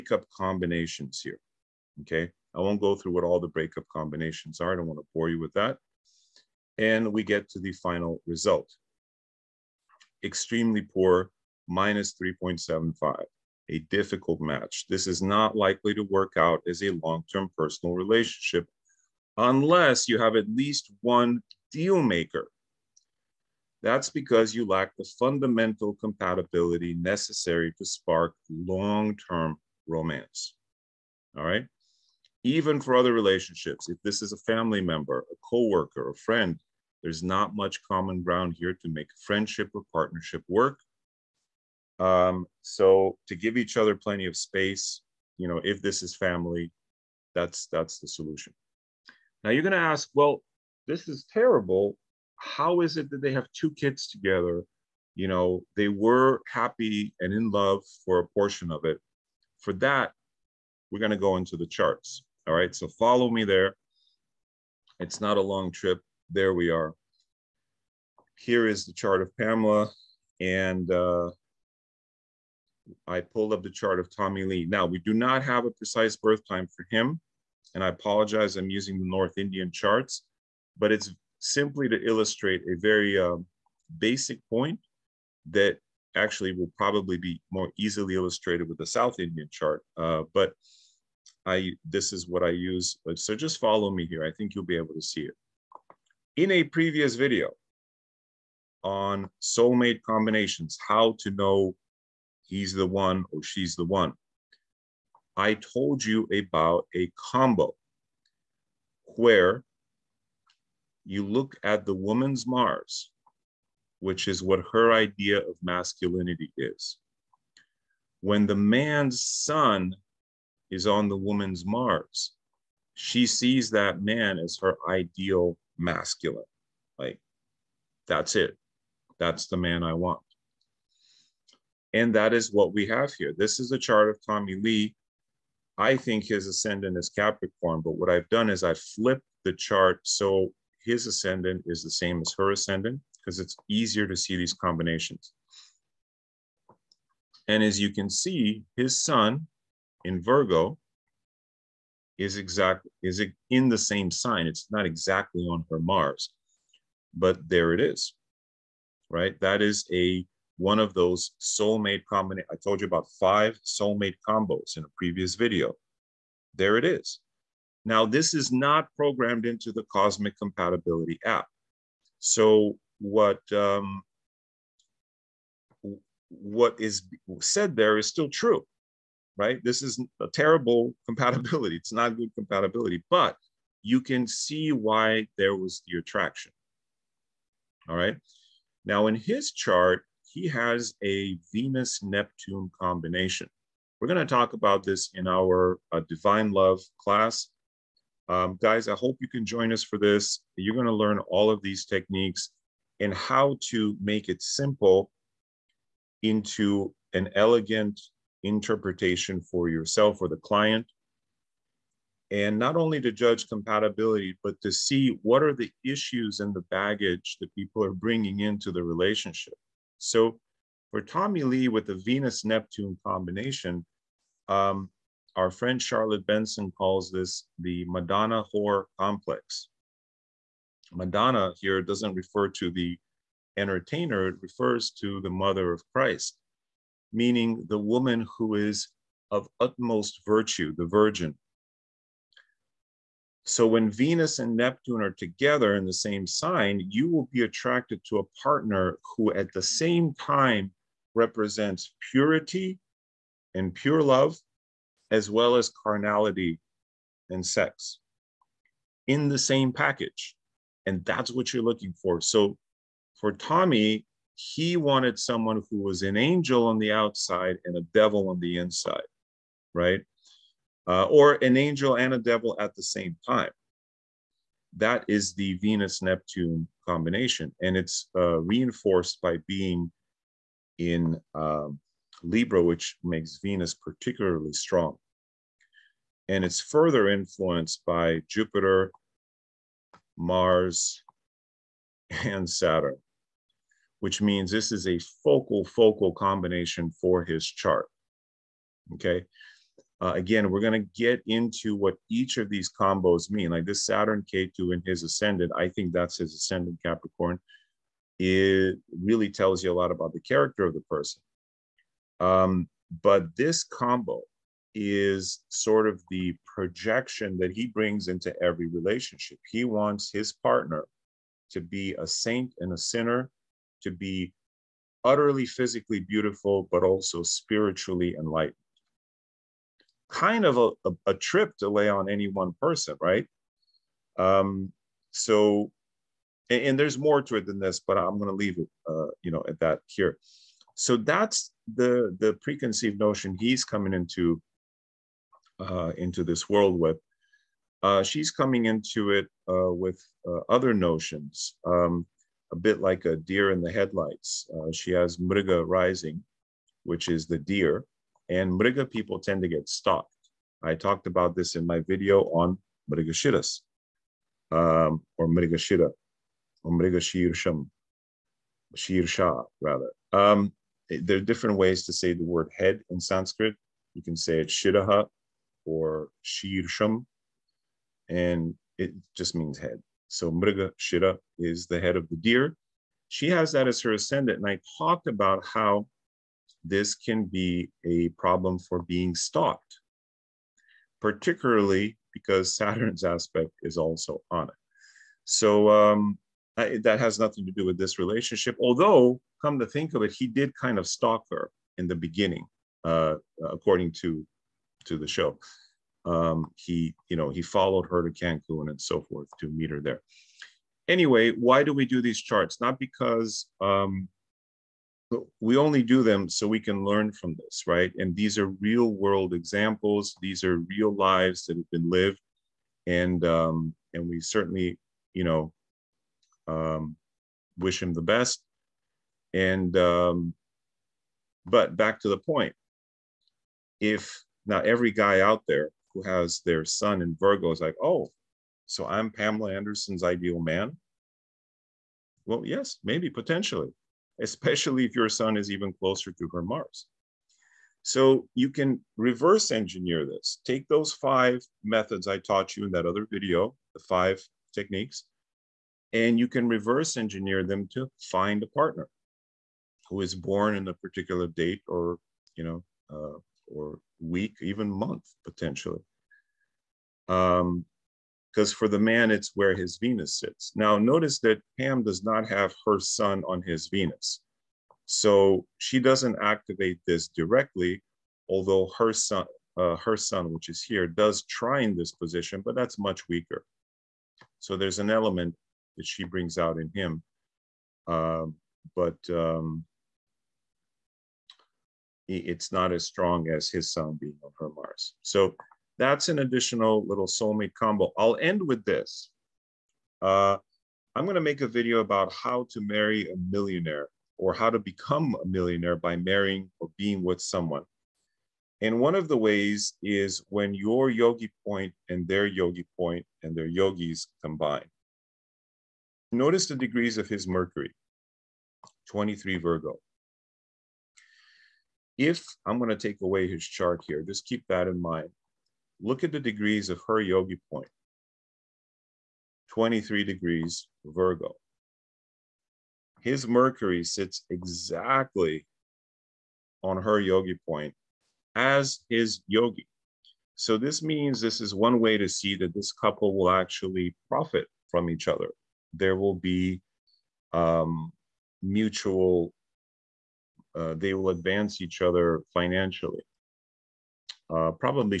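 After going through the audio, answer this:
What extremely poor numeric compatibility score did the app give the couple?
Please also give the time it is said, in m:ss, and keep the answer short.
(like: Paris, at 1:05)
-3.75, at 0:11.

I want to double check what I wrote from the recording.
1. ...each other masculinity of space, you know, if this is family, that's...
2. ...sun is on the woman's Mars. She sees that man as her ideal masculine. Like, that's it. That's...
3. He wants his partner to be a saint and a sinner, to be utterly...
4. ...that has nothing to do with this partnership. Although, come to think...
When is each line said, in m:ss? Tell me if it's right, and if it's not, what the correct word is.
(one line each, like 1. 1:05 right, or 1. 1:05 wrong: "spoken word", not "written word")
1. 0:43 wrong: "plenty", not "masculinity"
2. 1:59 right
3. 5:19 right
4. 6:36 wrong: "relationship", not "partnership".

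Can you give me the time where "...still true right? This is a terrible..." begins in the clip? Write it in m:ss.
2:58.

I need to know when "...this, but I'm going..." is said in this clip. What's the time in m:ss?
5:37.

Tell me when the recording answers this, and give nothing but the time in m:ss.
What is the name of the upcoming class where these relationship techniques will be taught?
3:16.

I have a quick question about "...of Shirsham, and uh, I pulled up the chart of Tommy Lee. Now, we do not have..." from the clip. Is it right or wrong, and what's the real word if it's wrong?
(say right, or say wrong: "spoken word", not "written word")
wrong: "Pamela", not "Shirsham".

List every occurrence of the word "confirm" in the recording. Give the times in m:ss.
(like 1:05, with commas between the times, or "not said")
not said.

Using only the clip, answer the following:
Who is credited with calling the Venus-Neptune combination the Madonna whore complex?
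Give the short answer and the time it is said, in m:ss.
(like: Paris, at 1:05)
Charlotte Benson, at 3:45.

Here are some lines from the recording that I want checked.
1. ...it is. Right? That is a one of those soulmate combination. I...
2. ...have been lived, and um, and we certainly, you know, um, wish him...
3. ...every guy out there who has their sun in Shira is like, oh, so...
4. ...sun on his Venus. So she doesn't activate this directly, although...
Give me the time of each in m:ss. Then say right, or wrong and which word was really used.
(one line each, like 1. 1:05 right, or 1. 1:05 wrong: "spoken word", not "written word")
1. 2:37 right
2. 7:01 right
3. 7:14 wrong: "Virgo", not "Shira"
4. 7:52 right.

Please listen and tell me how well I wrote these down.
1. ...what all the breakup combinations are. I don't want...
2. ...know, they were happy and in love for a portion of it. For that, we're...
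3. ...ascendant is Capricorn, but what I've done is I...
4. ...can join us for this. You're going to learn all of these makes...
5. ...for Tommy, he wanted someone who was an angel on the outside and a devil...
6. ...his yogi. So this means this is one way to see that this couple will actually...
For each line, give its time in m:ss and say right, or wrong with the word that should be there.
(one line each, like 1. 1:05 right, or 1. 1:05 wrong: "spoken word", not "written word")
1. 0:03 right
2. 0:55 right
3. 2:16 right
4. 3:19 wrong: "techniques", not "makes"
5. 4:23 right
6. 8:58 right.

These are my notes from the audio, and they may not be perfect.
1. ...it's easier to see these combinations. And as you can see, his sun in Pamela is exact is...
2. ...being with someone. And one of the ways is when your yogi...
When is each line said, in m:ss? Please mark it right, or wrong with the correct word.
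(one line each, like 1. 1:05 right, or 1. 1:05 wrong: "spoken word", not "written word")
1. 2:23 wrong: "Virgo", not "Pamela"
2. 8:26 right.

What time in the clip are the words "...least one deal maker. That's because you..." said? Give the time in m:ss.
0:20.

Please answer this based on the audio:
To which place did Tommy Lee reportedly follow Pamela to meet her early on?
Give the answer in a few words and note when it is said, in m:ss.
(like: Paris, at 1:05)
Cancun, at 6:48.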